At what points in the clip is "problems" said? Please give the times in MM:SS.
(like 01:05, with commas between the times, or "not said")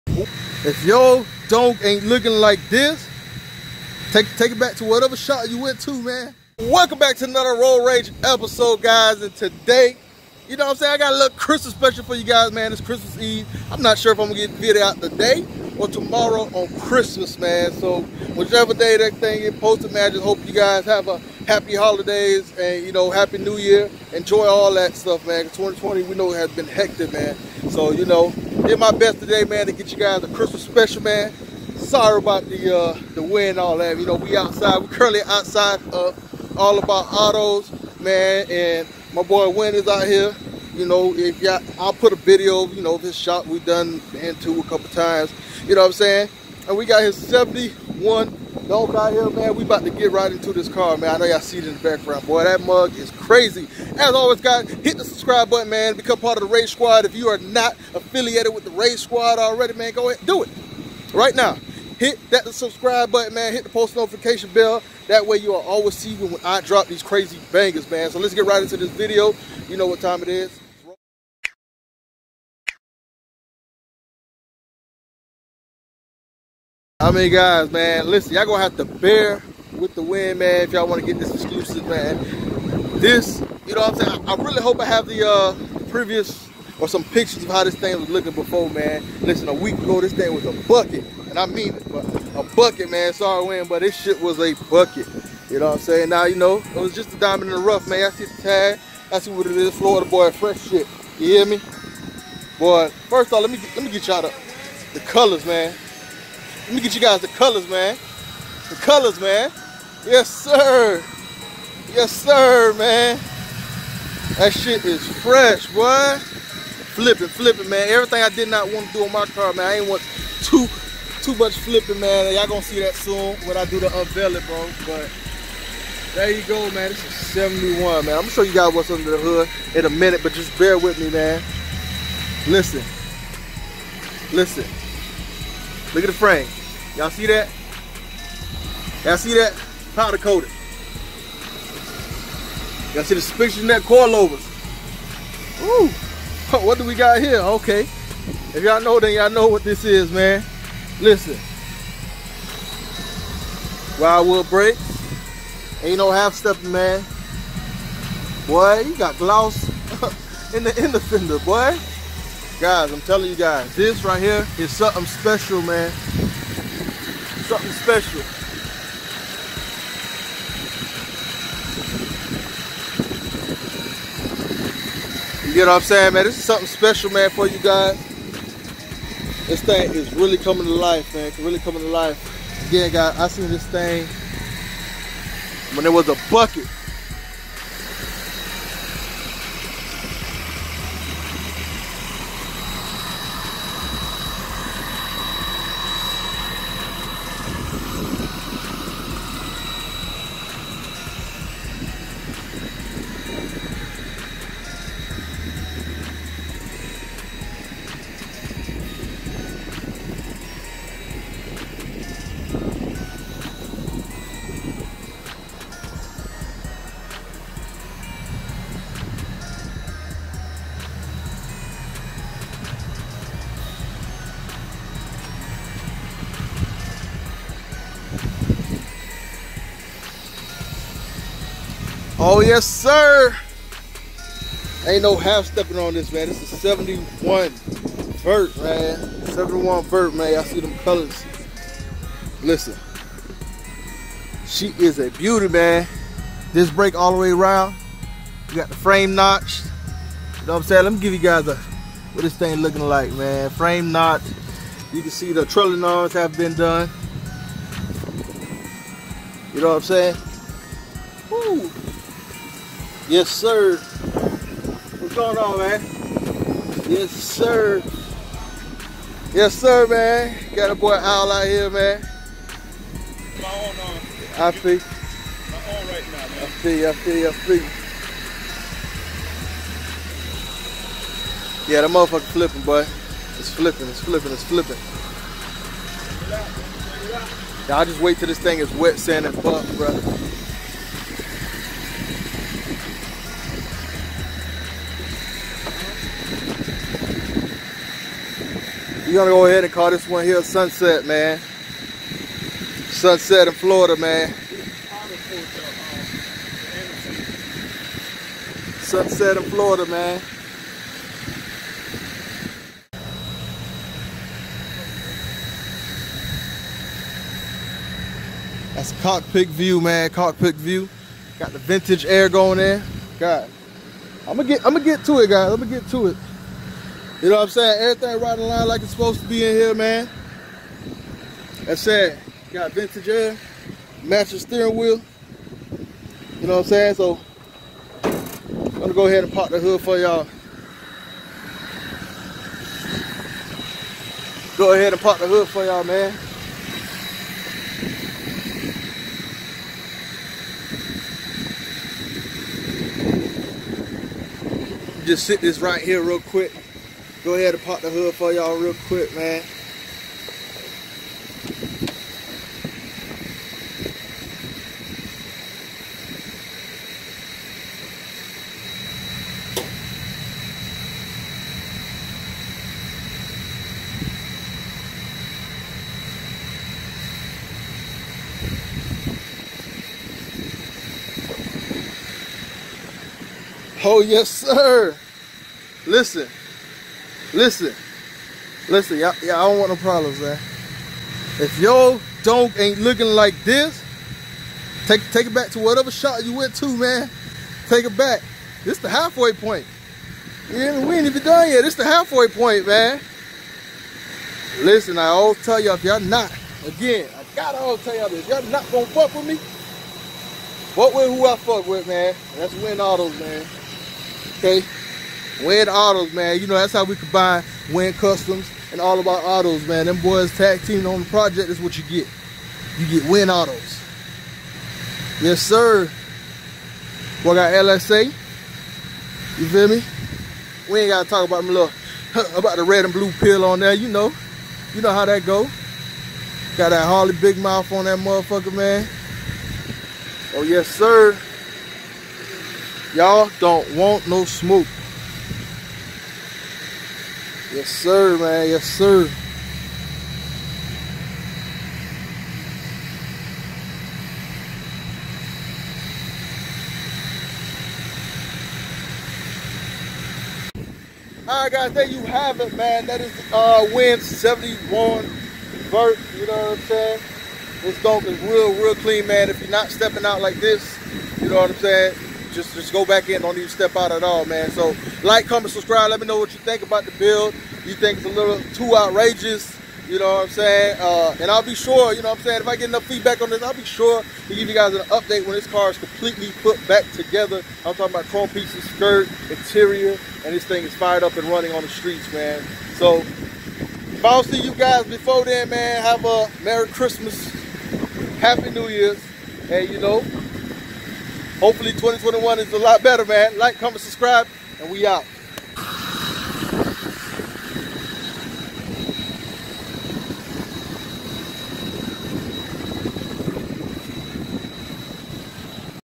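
06:29.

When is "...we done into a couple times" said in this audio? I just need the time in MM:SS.
00:43.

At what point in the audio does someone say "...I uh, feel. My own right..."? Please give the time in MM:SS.
04:34.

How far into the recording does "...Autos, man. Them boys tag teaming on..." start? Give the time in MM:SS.
06:59.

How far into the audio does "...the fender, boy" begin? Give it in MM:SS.
02:40.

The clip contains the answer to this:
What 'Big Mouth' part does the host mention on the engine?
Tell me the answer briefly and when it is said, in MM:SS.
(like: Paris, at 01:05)
Harley, at 07:16.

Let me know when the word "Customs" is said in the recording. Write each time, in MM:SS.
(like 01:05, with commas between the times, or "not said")
06:57.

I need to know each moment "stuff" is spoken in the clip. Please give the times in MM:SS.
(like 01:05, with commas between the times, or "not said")
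00:24.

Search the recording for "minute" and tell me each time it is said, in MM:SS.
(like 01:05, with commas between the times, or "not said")
02:09.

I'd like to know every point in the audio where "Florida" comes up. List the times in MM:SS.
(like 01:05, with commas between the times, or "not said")
01:39, 05:03, 05:09.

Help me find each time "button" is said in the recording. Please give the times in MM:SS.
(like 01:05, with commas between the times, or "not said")
00:55, 01:03.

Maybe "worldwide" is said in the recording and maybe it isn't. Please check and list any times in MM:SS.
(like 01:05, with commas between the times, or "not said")
not said.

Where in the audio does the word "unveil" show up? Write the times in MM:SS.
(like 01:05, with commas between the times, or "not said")
02:03.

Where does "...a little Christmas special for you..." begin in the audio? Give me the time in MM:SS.
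00:11.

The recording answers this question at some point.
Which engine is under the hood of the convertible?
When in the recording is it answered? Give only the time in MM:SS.
07:07.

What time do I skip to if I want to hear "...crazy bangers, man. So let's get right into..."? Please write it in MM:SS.
01:07.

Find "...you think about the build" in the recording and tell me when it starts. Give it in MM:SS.
07:56.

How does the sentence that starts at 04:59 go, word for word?
You're gonna go ahead and call this one here Sunset, man.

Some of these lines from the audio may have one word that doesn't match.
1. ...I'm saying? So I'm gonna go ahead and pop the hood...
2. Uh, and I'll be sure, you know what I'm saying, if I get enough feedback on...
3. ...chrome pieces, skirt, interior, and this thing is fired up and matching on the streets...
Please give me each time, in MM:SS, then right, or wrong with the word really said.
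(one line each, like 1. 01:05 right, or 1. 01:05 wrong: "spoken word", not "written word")
1. 05:36 right
2. 08:00 right
3. 08:08 wrong: "running", not "matching".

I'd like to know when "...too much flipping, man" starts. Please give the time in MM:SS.
02:01.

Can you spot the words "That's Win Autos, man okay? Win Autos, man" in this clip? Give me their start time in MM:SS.
06:52.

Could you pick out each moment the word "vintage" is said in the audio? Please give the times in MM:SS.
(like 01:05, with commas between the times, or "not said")
05:21, 05:32.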